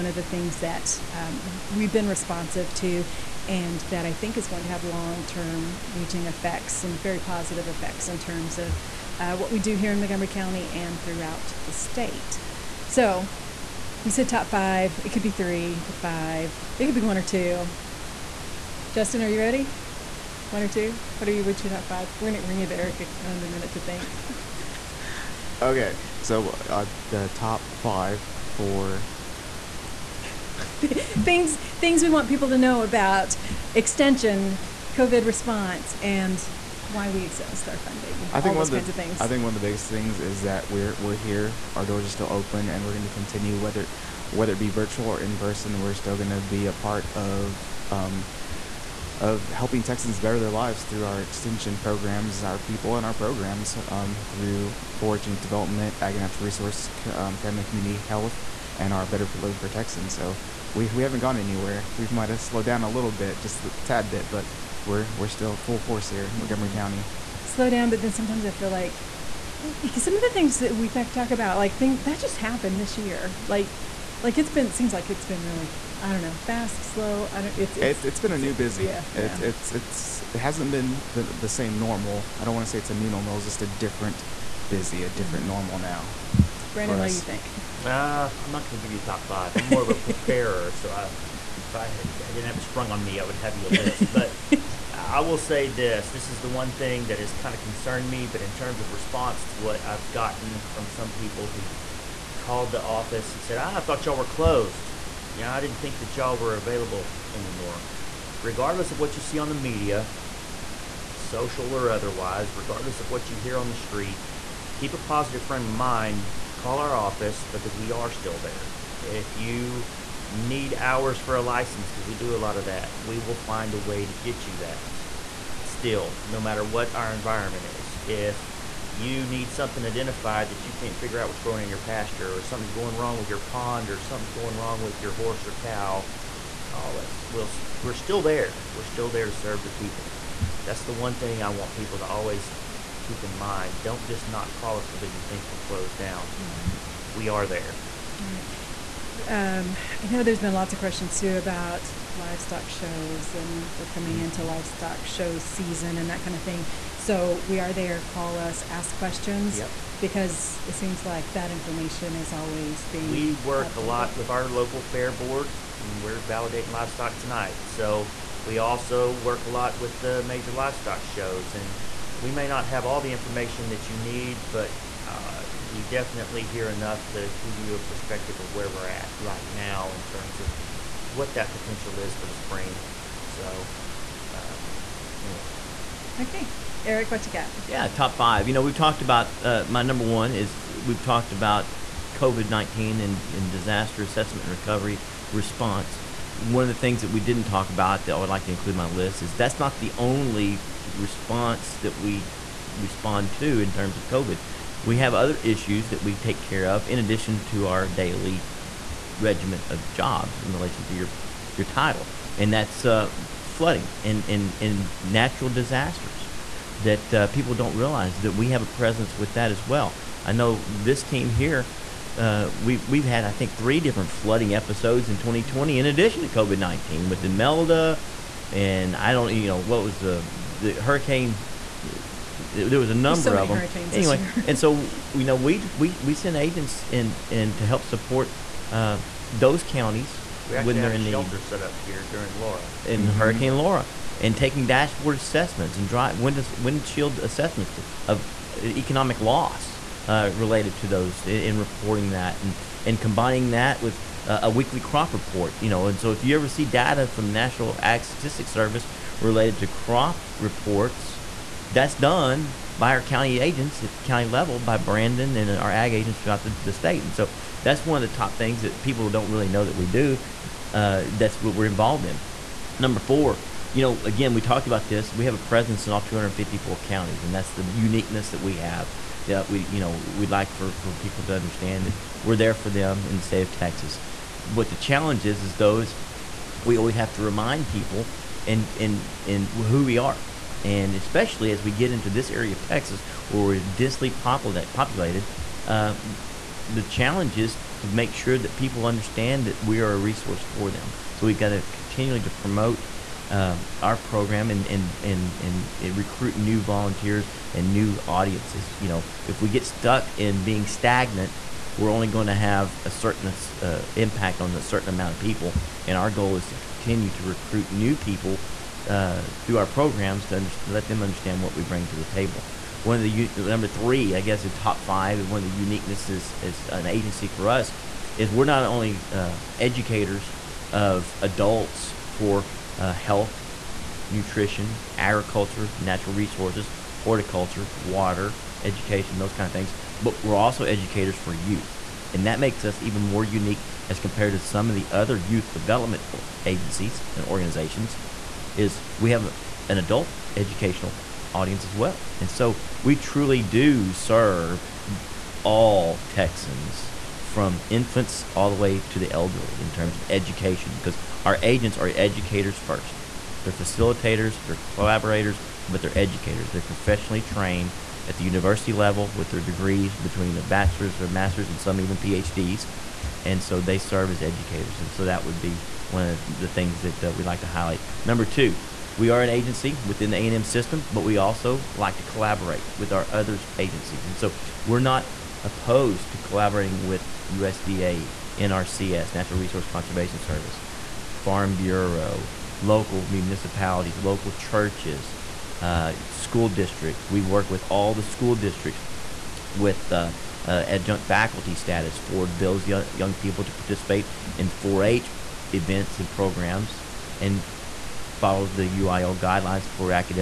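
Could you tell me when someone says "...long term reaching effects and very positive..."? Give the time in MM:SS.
00:04.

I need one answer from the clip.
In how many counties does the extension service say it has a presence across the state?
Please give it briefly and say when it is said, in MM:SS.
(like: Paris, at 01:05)
254, at 04:36.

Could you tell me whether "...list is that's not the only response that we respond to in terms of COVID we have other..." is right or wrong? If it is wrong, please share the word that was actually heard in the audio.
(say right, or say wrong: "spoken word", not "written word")
right.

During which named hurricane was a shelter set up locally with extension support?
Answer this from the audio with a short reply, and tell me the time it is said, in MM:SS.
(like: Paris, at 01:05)
Hurricane Laura, at 04:03.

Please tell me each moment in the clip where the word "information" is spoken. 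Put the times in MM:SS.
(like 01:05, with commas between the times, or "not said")
02:41, 02:53.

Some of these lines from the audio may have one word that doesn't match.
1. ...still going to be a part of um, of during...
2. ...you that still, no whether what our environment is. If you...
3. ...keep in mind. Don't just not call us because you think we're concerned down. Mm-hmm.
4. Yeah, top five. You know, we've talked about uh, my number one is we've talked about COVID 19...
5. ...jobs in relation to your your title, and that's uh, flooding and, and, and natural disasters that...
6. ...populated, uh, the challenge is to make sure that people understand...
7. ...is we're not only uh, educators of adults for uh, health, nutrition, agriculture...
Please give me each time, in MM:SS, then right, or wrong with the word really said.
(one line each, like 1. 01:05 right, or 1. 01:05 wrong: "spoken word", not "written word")
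1. 00:45 wrong: "helping", not "during"
2. 02:04 wrong: "matter", not "whether"
3. 02:23 wrong: "closed", not "concerned"
4. 03:07 right
5. 03:29 right
6. 04:54 right
7. 05:28 right.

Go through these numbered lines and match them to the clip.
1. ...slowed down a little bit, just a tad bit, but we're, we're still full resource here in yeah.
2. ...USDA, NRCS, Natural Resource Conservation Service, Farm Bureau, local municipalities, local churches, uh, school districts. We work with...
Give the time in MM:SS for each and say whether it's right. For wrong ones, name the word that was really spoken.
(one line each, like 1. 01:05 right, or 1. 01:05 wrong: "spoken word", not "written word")
1. 01:02 wrong: "force", not "resource"
2. 06:27 right.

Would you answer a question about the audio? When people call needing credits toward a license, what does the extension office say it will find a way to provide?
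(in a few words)
hours.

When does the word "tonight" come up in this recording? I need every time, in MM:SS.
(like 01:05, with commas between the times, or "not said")
02:47.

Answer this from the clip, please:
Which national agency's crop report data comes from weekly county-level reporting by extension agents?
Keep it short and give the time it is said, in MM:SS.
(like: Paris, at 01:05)
National Ag Statistics Service, at 04:17.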